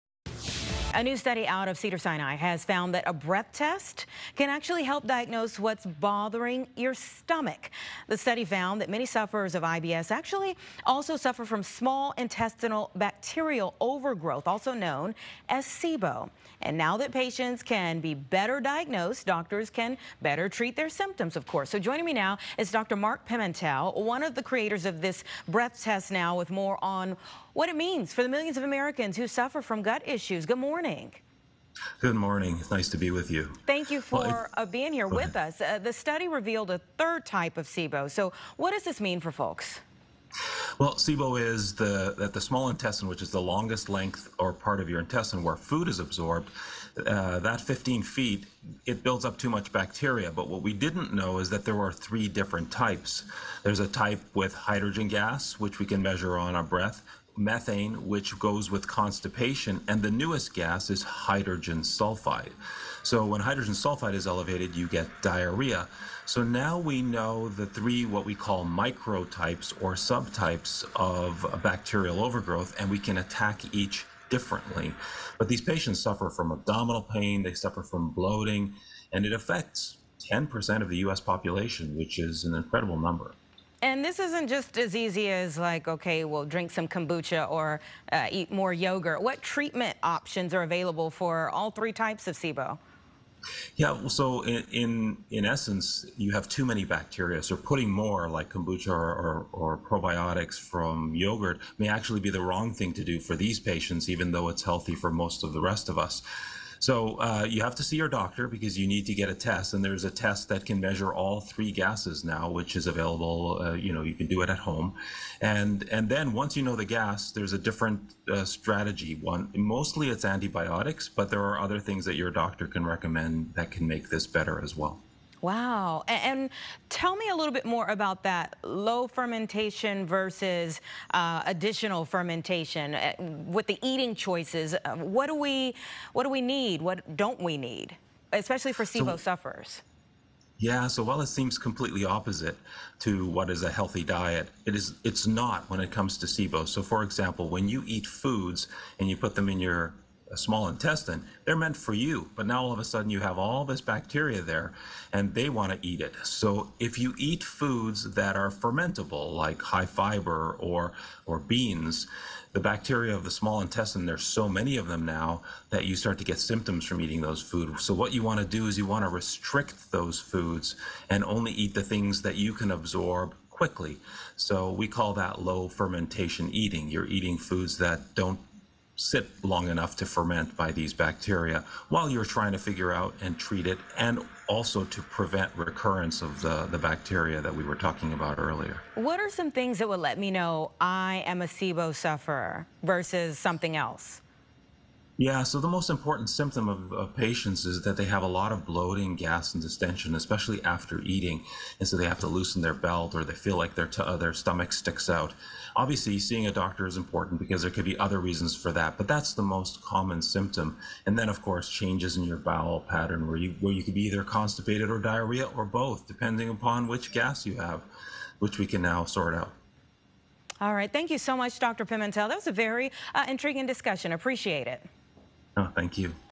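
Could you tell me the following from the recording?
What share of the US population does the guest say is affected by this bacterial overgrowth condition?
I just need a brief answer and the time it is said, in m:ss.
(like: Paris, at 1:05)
10%, at 1:20.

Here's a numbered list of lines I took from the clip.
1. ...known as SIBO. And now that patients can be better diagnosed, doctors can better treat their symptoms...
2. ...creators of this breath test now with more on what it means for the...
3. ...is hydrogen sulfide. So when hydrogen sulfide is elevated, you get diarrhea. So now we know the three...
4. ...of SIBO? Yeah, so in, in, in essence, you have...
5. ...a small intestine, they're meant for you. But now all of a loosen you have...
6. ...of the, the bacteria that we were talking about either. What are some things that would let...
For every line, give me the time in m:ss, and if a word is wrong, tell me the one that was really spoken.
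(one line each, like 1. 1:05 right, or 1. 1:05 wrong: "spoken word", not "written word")
1. 0:14 right
2. 0:24 right
3. 1:00 right
4. 1:32 right
5. 2:30 wrong: "sudden", not "loosen"
6. 3:06 wrong: "earlier", not "either".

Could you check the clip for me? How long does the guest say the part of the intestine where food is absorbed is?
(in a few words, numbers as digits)
15 feet.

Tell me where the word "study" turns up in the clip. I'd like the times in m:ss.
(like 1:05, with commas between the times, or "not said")
0:01, 0:08, 0:35.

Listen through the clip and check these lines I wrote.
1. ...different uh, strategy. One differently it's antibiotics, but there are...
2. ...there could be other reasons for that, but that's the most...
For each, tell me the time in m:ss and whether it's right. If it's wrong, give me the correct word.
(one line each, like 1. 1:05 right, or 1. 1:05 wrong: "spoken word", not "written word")
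1. 1:57 wrong: "mostly", not "differently"
2. 3:27 right.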